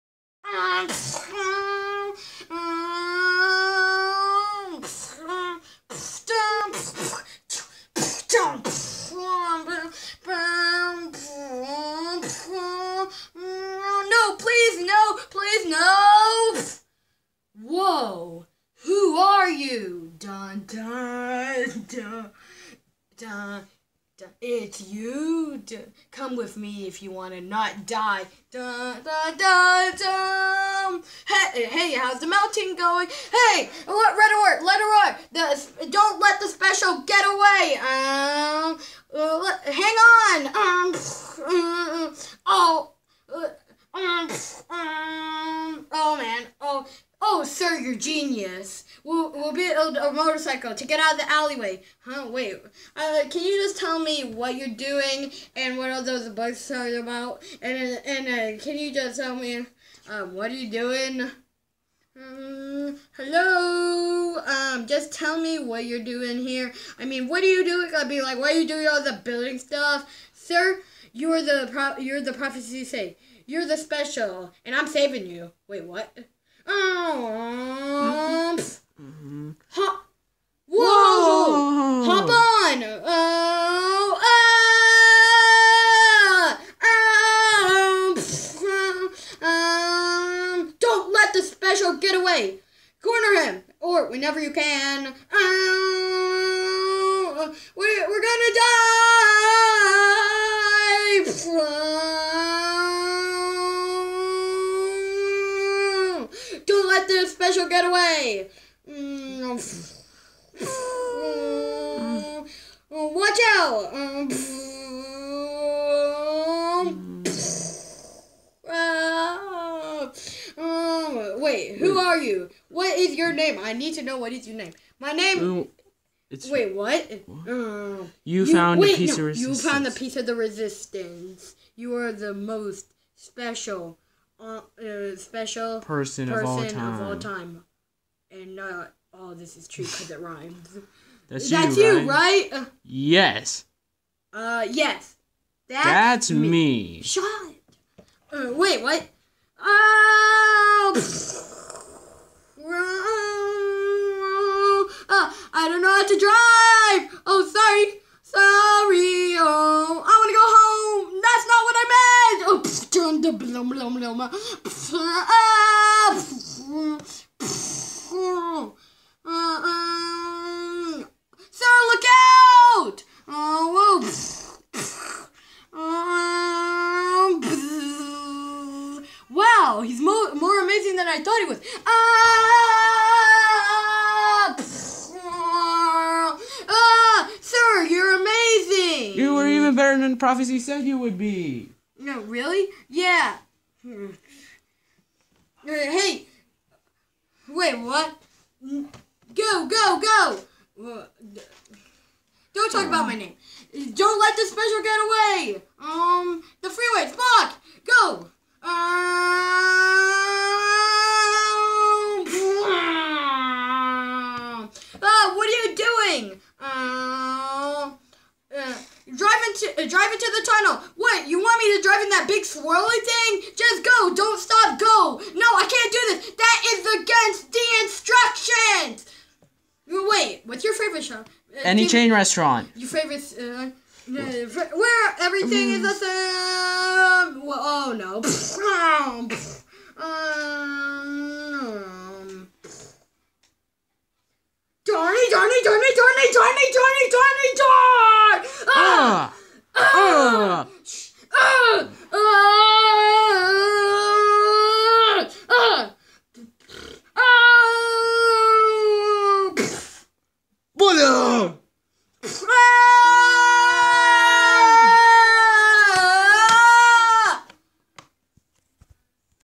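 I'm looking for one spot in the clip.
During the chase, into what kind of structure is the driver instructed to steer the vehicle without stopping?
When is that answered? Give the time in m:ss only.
3:40.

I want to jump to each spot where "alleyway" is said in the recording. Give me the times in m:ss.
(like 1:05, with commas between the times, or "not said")
0:51.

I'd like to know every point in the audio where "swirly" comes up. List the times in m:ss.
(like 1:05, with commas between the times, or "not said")
3:42.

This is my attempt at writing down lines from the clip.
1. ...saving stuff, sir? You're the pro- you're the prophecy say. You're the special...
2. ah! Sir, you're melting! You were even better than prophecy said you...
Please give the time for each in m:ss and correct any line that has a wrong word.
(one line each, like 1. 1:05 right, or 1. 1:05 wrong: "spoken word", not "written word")
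1. 1:09 wrong: "building", not "saving"
2. 3:06 wrong: "amazing", not "melting".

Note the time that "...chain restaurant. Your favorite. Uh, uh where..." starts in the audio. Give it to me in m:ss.
3:51.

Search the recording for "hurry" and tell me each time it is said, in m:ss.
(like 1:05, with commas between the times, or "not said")
not said.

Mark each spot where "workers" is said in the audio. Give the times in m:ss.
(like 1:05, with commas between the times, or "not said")
not said.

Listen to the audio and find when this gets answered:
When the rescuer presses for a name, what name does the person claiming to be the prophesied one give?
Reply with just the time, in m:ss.
2:27.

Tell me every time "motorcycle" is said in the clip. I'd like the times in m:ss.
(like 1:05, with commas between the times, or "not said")
0:50.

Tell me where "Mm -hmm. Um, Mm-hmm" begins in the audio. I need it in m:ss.
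1:17.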